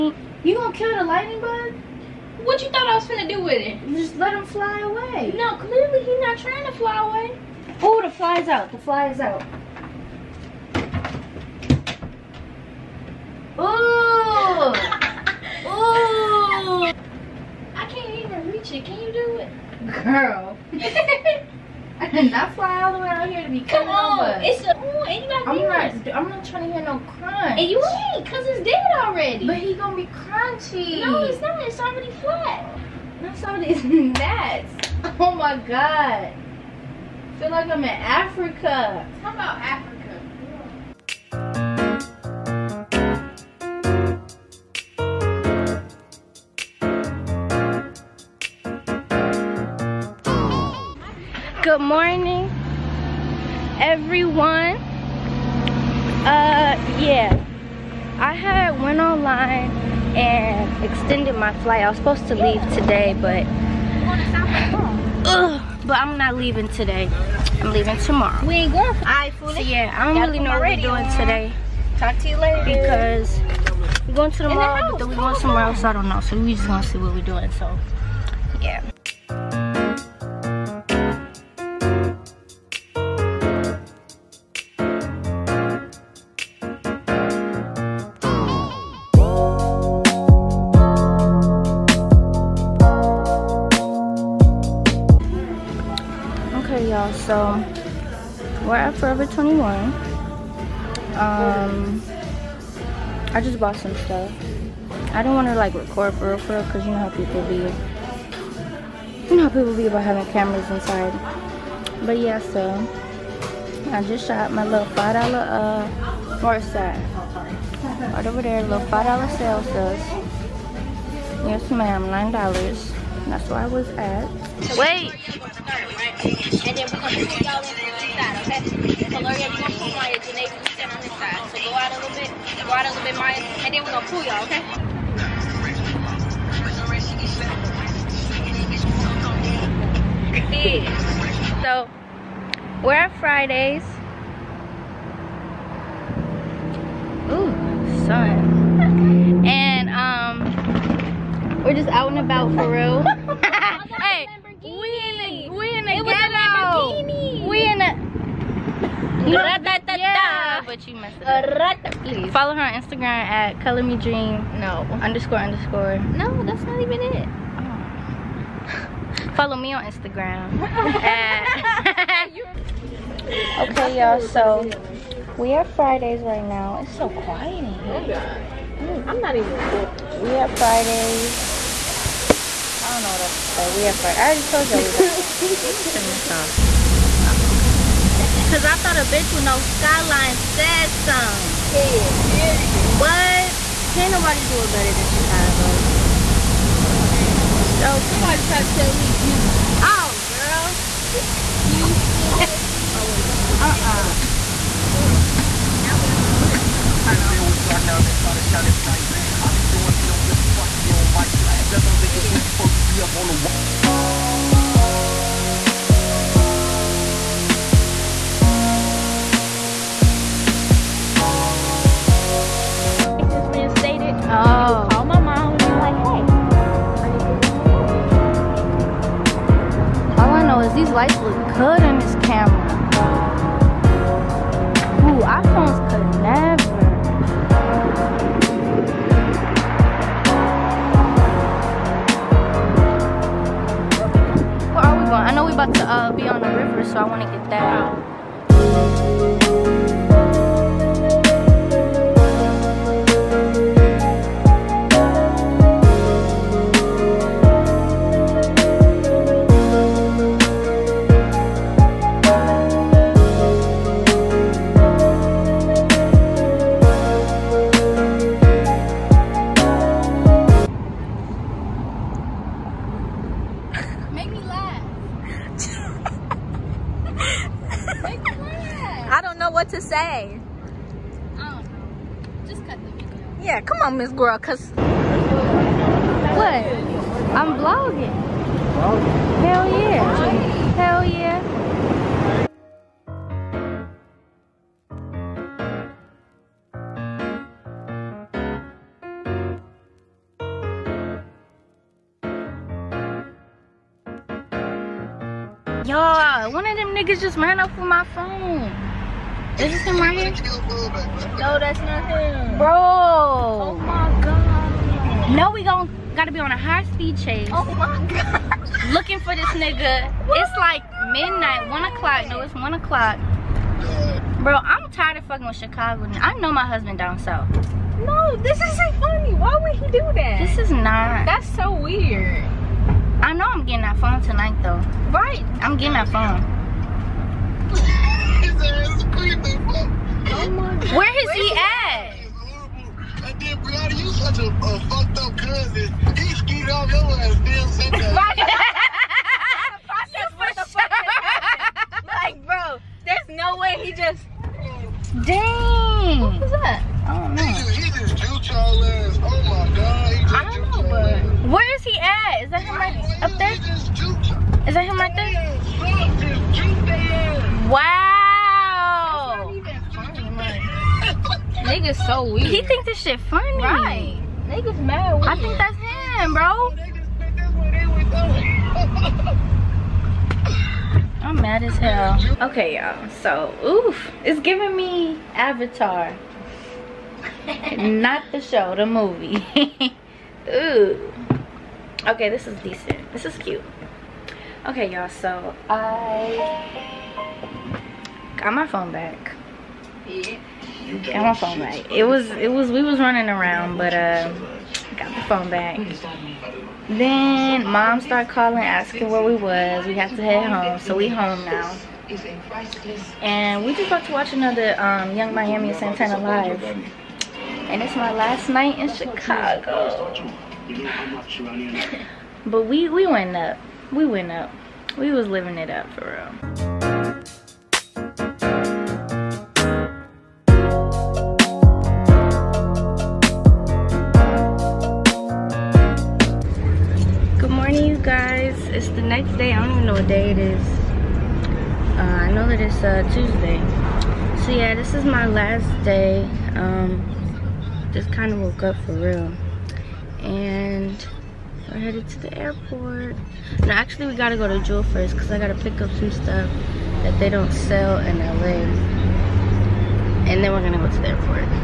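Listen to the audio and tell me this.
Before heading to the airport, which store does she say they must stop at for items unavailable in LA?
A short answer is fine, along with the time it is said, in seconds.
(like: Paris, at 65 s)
Jewel, at 454 s.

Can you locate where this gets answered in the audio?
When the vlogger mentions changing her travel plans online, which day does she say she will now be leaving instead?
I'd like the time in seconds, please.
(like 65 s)
67 s.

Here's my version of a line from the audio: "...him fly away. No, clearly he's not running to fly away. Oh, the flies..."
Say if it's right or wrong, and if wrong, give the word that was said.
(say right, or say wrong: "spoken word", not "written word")
wrong: "trying", not "running".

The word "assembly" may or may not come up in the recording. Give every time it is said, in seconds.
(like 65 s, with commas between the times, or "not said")
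not said.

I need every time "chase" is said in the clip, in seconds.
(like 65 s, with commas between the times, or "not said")
317 s.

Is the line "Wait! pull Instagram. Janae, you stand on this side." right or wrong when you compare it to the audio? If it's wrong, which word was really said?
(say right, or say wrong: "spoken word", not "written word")
wrong: "Maya", not "Instagram".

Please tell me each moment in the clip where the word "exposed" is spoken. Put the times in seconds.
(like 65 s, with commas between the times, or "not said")
not said.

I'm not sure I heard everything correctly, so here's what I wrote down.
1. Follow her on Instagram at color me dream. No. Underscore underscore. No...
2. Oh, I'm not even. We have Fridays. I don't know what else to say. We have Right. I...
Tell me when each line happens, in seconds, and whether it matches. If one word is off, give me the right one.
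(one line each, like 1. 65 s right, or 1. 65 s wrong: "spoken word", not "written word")
1. 162 s right
2. 178 s wrong: "Friday", not "Right".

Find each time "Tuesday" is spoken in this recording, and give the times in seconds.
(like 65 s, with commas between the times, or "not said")
443 s.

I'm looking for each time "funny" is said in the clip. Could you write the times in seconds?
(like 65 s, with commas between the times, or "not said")
328 s, 373 s.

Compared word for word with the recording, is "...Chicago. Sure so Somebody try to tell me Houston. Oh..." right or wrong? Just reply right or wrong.
right.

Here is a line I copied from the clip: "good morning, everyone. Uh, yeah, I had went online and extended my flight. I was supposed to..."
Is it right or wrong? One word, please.
right.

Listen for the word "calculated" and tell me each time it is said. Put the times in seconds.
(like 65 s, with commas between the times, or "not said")
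not said.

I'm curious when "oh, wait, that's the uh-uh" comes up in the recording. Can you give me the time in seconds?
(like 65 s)
202 s.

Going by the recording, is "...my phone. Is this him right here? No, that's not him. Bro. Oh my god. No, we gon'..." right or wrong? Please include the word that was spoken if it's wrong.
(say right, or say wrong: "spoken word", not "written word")
right.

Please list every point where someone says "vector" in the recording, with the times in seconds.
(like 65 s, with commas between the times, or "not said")
not said.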